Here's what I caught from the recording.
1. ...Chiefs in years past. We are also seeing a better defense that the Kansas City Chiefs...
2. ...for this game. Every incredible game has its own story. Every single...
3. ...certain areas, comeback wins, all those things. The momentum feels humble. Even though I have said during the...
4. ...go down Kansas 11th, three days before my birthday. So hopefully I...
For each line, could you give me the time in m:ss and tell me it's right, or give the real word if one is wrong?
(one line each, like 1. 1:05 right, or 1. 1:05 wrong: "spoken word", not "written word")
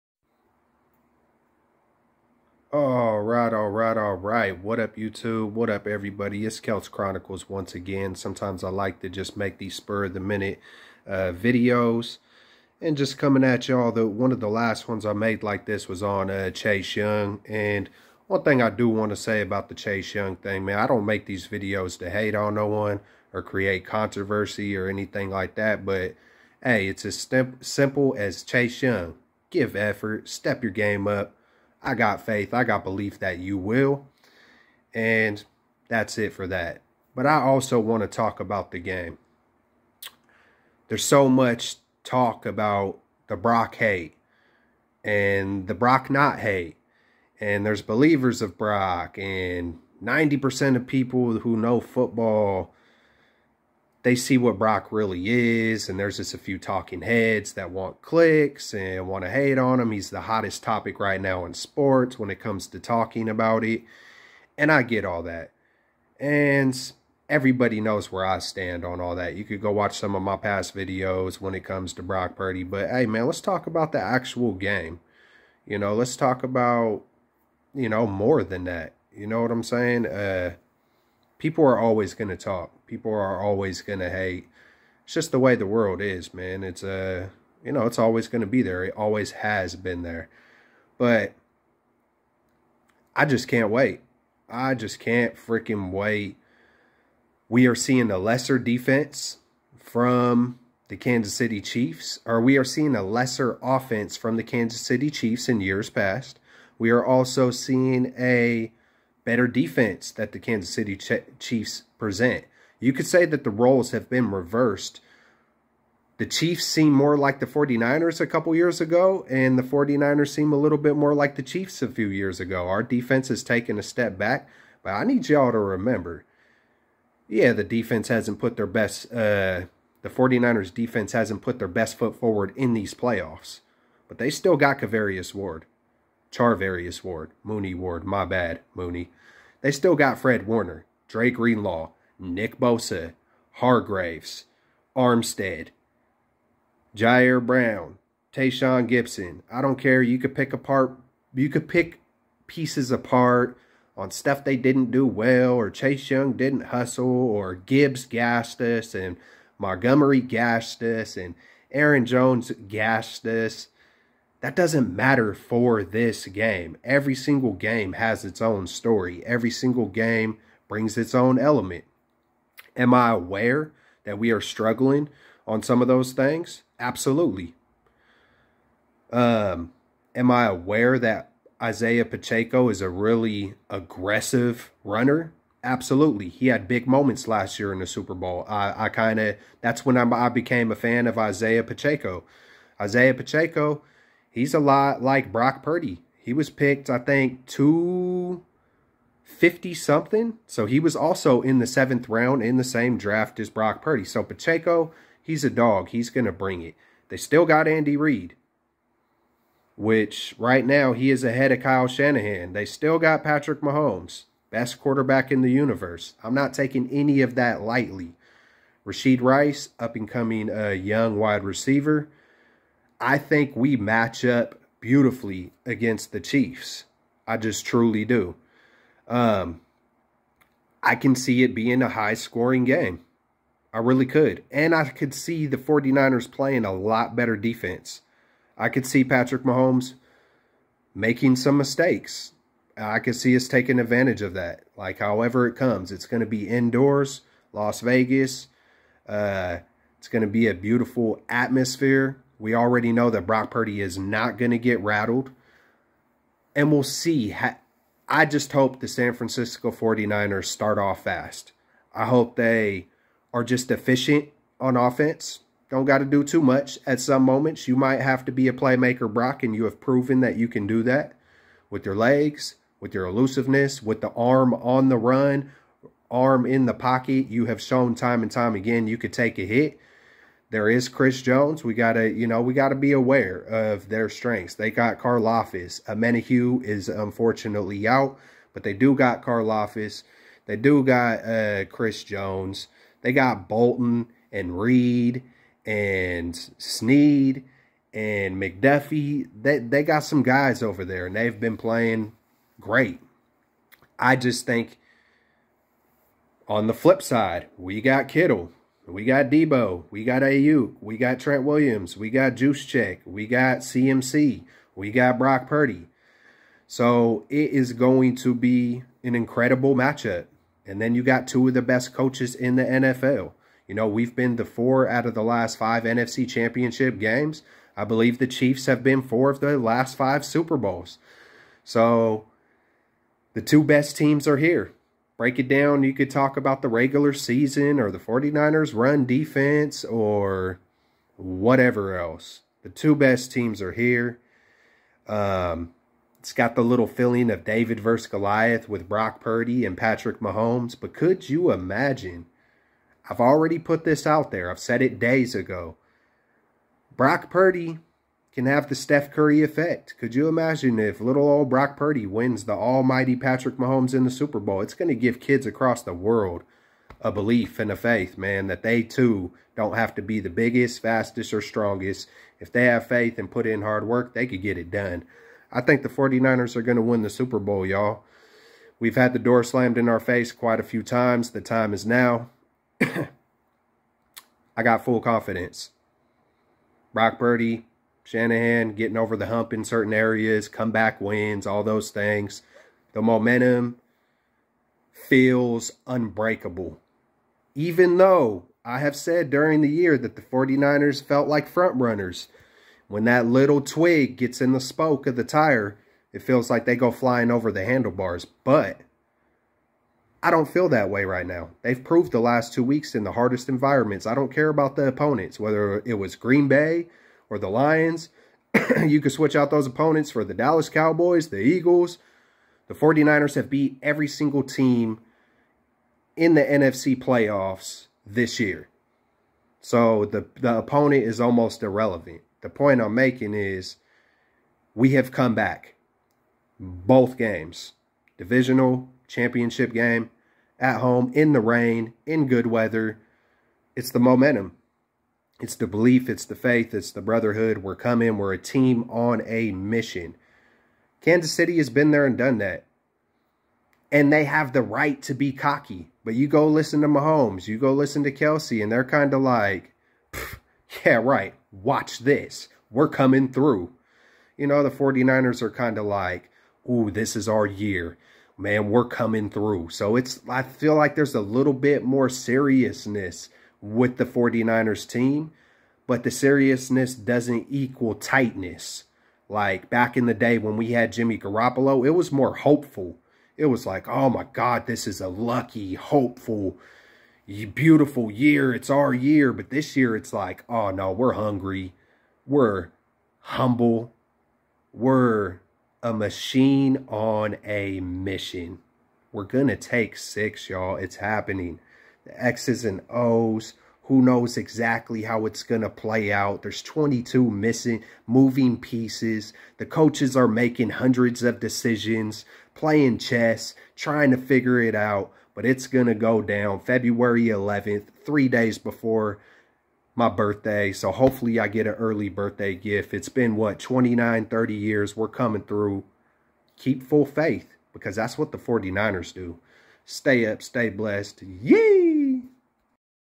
1. 1:45 right
2. 2:45 wrong: "single", not "incredible"
3. 6:29 wrong: "unbreakable", not "humble"
4. 8:35 wrong: "February", not "Kansas".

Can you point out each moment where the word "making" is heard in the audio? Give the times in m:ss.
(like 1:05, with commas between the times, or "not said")
4:00, 7:12, 8:30.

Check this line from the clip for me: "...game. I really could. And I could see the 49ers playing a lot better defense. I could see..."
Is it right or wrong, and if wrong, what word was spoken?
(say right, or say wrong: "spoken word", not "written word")
right.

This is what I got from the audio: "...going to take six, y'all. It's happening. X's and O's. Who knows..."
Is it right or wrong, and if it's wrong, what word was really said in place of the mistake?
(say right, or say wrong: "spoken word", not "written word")
right.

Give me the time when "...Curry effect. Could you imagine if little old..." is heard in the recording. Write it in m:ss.
5:59.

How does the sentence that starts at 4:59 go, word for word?
They they got some guys over there, and they've been playing great.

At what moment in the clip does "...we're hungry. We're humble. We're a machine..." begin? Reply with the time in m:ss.
8:10.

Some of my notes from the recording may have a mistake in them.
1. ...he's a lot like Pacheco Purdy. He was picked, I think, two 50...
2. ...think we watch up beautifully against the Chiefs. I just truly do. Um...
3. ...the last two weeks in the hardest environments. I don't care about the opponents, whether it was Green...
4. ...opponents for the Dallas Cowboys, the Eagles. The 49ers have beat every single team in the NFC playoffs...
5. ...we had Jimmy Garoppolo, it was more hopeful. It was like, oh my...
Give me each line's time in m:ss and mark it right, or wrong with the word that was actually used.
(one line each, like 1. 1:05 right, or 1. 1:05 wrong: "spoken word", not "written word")
1. 3:14 wrong: "Brock", not "Pacheco"
2. 3:43 wrong: "match", not "watch"
3. 6:52 right
4. 6:59 right
5. 8:00 right.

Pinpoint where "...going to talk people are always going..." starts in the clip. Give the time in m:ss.
1:22.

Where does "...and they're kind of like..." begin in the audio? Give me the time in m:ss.
7:38.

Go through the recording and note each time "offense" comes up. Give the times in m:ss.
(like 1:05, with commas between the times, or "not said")
1:43, 4:24.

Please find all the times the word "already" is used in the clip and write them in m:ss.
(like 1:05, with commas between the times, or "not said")
4:12, 5:53.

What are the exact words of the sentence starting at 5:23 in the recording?
You know, we've been the four out of the last five NFC championship games.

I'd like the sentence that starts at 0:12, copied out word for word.
And just coming at y'all, the one of the last ones I made like this was on uh, Chase Young.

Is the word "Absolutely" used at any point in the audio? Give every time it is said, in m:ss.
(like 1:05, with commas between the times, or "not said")
2:56, 3:05.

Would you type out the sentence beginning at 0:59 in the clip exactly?
He's the hottest topic right now in sports when it comes to talking about it, and I get all that.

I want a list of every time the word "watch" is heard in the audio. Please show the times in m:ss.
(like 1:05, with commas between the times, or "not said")
1:09, 7:41.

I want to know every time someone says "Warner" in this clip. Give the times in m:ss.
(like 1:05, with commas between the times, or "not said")
2:20.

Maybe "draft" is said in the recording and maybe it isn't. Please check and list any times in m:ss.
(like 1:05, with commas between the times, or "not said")
3:22.